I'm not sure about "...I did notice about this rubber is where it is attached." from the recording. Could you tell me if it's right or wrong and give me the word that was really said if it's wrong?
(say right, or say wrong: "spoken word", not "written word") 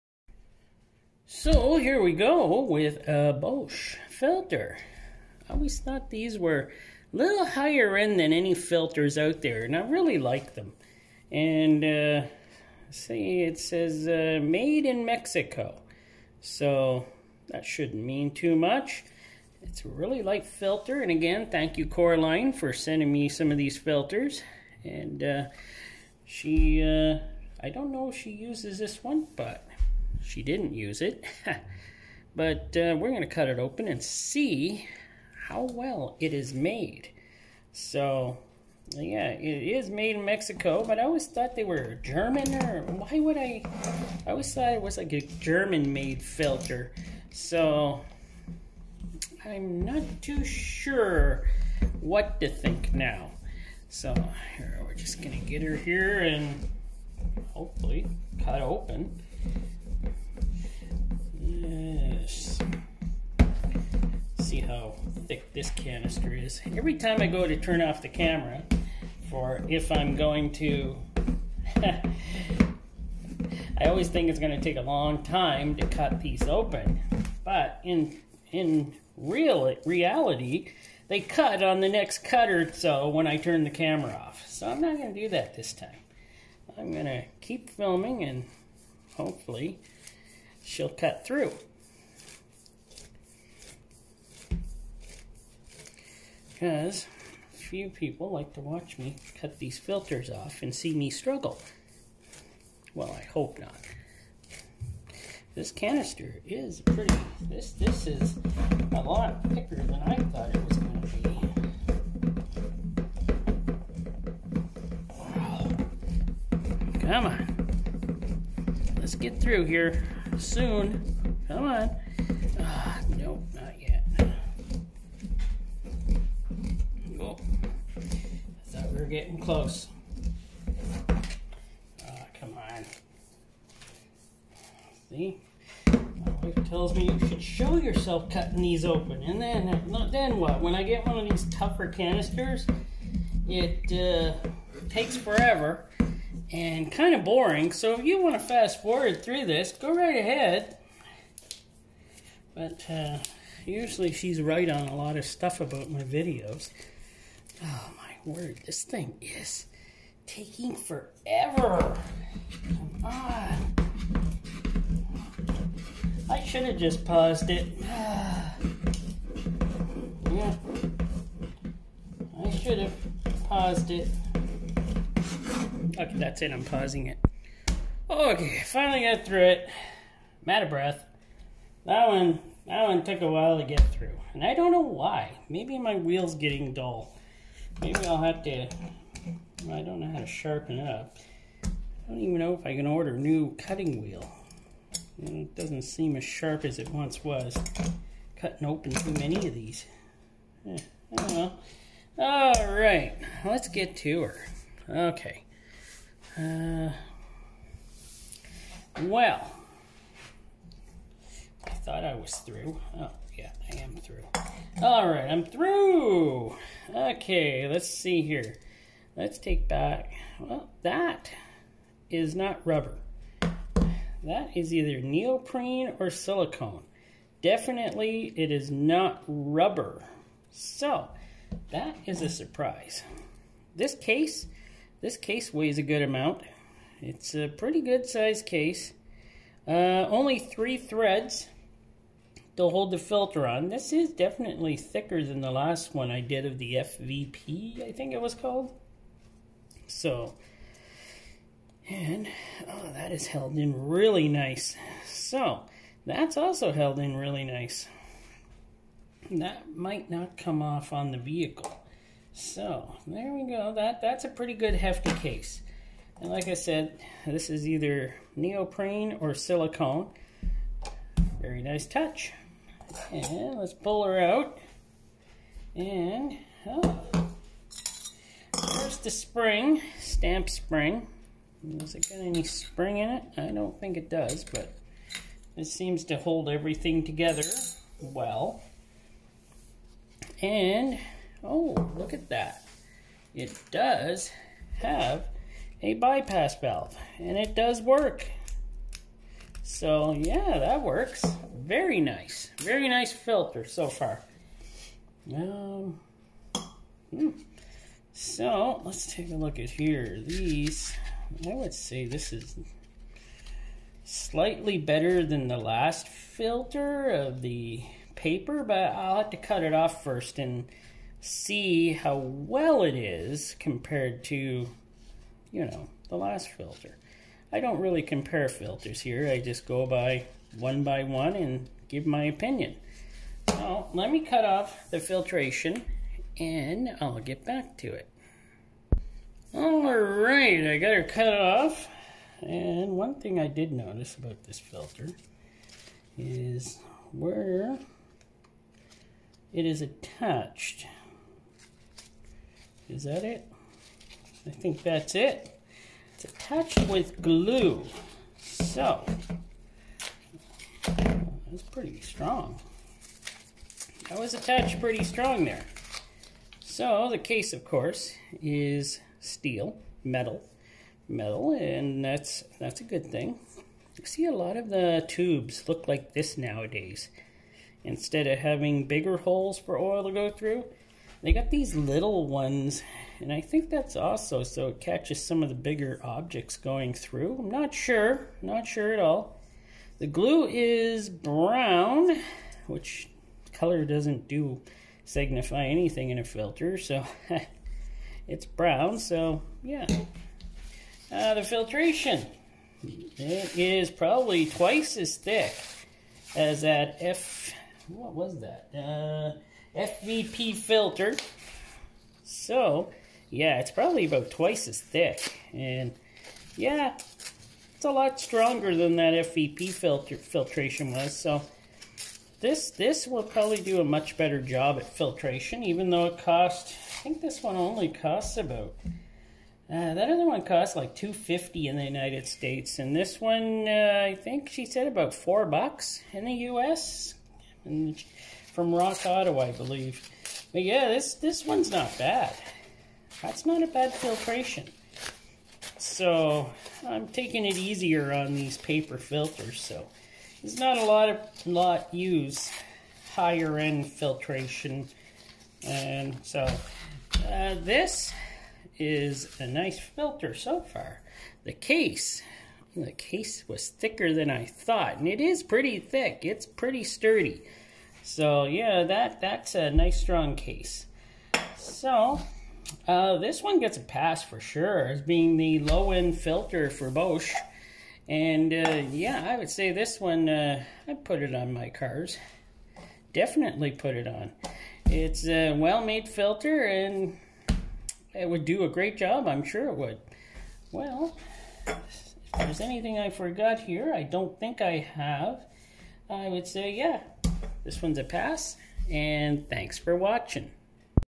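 wrong: "filter", not "rubber".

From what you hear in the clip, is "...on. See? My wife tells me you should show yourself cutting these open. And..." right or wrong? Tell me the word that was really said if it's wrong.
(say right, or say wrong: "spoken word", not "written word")
right.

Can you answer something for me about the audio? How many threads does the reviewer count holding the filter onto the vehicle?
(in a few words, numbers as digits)
3.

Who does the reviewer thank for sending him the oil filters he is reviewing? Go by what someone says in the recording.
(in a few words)
Coraline.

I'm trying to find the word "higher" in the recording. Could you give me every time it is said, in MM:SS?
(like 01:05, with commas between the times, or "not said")
00:07, 07:33.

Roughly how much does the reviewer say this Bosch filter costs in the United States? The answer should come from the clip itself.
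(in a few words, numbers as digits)
About $4.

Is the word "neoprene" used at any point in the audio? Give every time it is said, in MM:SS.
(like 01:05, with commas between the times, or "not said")
03:45, 04:28.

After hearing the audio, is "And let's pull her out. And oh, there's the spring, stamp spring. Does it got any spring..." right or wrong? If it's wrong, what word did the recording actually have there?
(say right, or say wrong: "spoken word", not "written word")
right.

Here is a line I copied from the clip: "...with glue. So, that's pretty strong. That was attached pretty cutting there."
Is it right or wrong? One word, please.
wrong.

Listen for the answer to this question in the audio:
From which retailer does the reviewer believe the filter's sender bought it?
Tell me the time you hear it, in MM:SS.
07:18.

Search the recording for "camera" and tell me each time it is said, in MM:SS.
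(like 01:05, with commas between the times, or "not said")
01:08, 01:23.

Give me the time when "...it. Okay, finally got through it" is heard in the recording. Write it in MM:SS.
02:57.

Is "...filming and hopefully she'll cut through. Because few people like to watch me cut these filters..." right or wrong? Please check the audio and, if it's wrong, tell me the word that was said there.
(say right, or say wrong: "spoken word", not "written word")
right.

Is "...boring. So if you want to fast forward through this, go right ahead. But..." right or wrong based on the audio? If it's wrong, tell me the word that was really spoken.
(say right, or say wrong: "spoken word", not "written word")
right.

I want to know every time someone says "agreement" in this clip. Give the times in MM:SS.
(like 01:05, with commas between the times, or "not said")
not said.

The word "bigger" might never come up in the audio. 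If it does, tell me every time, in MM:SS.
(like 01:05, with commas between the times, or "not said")
06:18, 06:25.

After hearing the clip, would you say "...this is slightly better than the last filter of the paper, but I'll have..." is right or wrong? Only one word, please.
right.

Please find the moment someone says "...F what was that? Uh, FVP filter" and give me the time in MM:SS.
06:46.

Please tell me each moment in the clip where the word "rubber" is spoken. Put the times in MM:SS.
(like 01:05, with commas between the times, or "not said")
03:42, 03:49.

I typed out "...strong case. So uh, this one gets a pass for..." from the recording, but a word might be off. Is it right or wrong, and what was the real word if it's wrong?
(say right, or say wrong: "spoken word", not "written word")
right.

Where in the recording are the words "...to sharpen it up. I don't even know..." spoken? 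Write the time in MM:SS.
03:10.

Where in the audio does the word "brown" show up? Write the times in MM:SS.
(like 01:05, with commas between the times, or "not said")
06:31, 06:38.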